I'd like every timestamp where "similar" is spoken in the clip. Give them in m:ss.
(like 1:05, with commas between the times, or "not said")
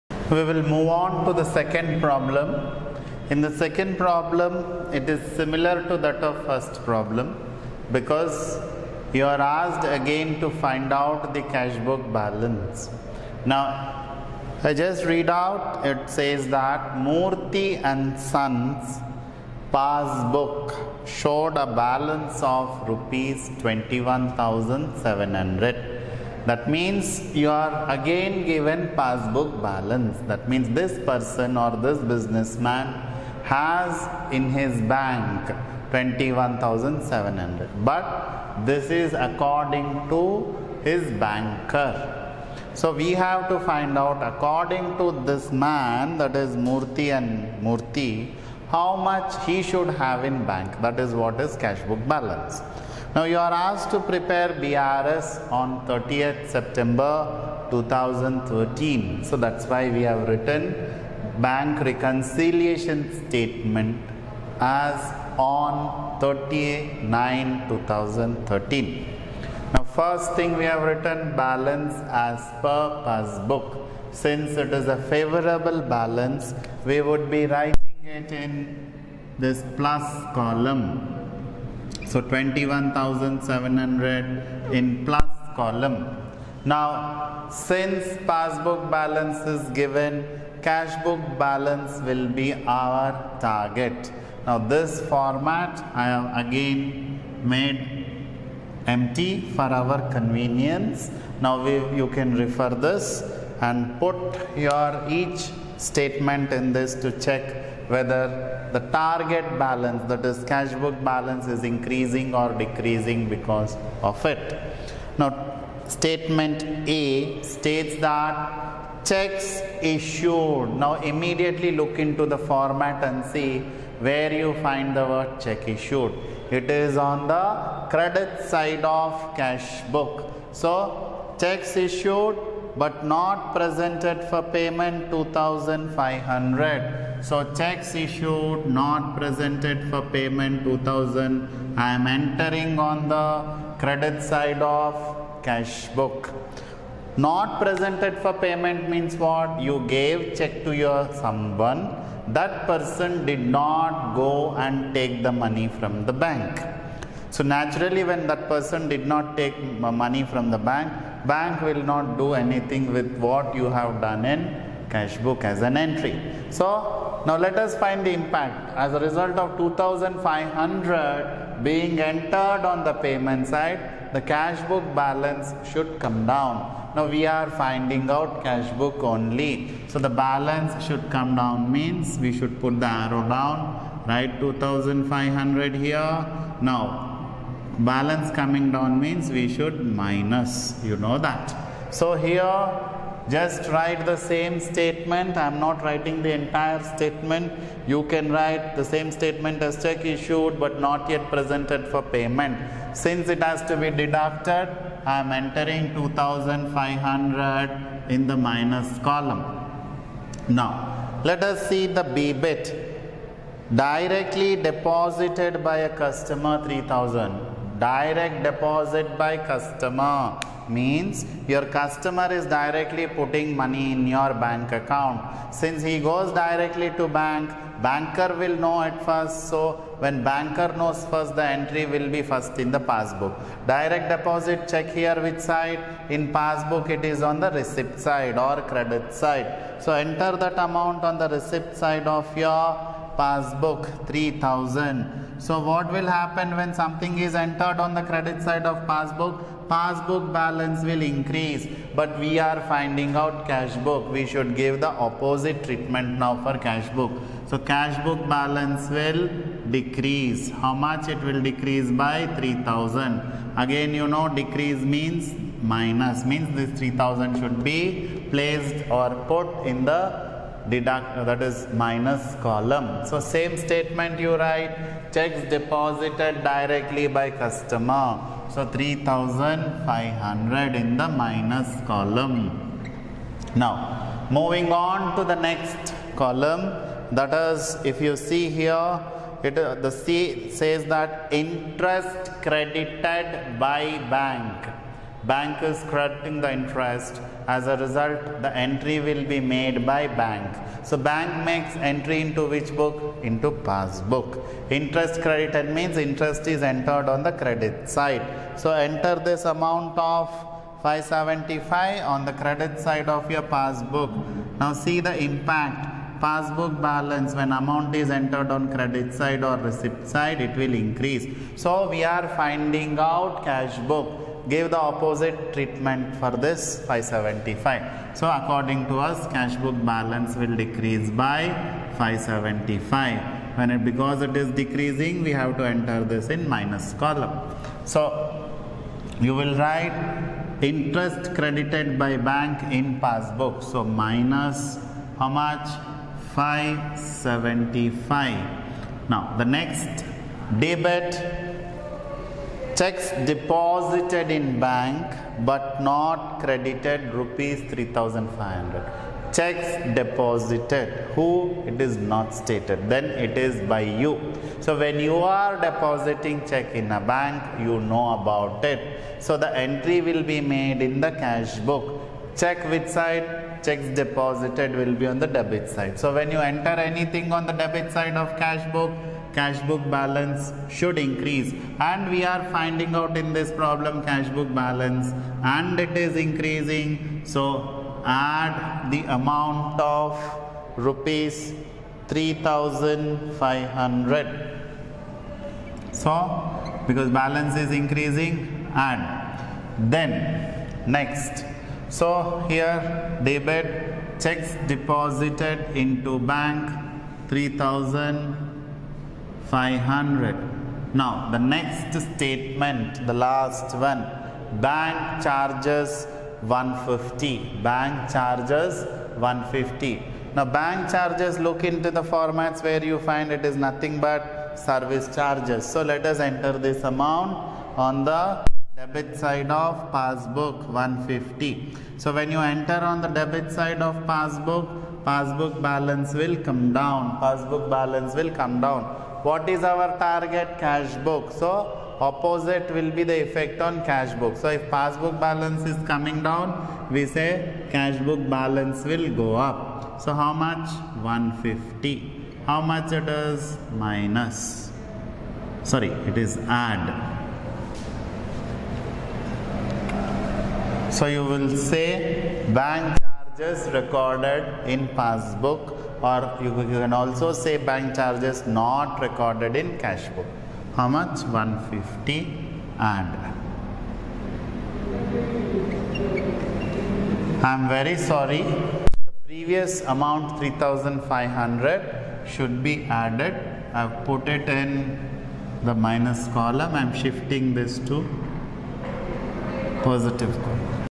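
0:05.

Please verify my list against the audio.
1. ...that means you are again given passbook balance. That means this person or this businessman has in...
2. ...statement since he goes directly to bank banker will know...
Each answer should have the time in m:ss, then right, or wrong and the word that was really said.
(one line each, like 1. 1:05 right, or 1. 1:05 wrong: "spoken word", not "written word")
1. 0:26 right
2. 3:44 wrong: "account", not "statement".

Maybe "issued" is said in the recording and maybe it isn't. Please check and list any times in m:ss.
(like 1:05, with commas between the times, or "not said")
1:59, 2:05, 2:11, 2:17, 3:20.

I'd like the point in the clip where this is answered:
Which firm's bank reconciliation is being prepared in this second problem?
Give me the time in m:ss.
0:17.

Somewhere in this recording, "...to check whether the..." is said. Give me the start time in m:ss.
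1:46.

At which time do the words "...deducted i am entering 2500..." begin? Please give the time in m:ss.
3:23.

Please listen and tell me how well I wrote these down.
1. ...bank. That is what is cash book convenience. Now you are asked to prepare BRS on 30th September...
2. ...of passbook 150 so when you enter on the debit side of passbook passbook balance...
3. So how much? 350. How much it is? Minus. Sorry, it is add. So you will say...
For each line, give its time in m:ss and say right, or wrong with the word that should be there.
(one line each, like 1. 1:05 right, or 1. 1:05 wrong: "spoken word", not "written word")
1. 0:50 wrong: "balance", not "convenience"
2. 7:09 right
3. 7:30 wrong: "150", not "350".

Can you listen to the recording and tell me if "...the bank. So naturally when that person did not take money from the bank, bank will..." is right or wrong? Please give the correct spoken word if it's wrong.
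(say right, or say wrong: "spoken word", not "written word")
right.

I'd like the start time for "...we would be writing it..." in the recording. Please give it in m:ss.
1:16.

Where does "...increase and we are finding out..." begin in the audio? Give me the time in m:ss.
6:20.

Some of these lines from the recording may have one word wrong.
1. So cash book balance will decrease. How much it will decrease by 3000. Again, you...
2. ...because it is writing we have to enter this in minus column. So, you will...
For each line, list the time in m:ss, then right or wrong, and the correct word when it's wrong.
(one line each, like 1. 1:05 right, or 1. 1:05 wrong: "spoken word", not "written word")
1. 4:17 right
2. 5:33 wrong: "decreasing", not "writing".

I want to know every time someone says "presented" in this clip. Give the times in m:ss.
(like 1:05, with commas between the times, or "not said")
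2:13, 2:19, 2:27, 3:21.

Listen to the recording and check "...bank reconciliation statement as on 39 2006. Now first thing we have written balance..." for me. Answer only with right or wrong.
wrong.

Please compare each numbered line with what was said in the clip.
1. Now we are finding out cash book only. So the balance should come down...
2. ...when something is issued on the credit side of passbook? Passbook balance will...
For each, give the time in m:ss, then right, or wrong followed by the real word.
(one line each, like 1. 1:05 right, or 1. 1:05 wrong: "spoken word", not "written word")
1. 2:56 right
2. 4:06 wrong: "entered", not "issued".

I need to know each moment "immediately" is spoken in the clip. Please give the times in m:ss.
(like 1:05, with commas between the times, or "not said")
2:01.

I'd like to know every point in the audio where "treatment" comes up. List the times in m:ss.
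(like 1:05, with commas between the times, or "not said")
4:15, 5:25.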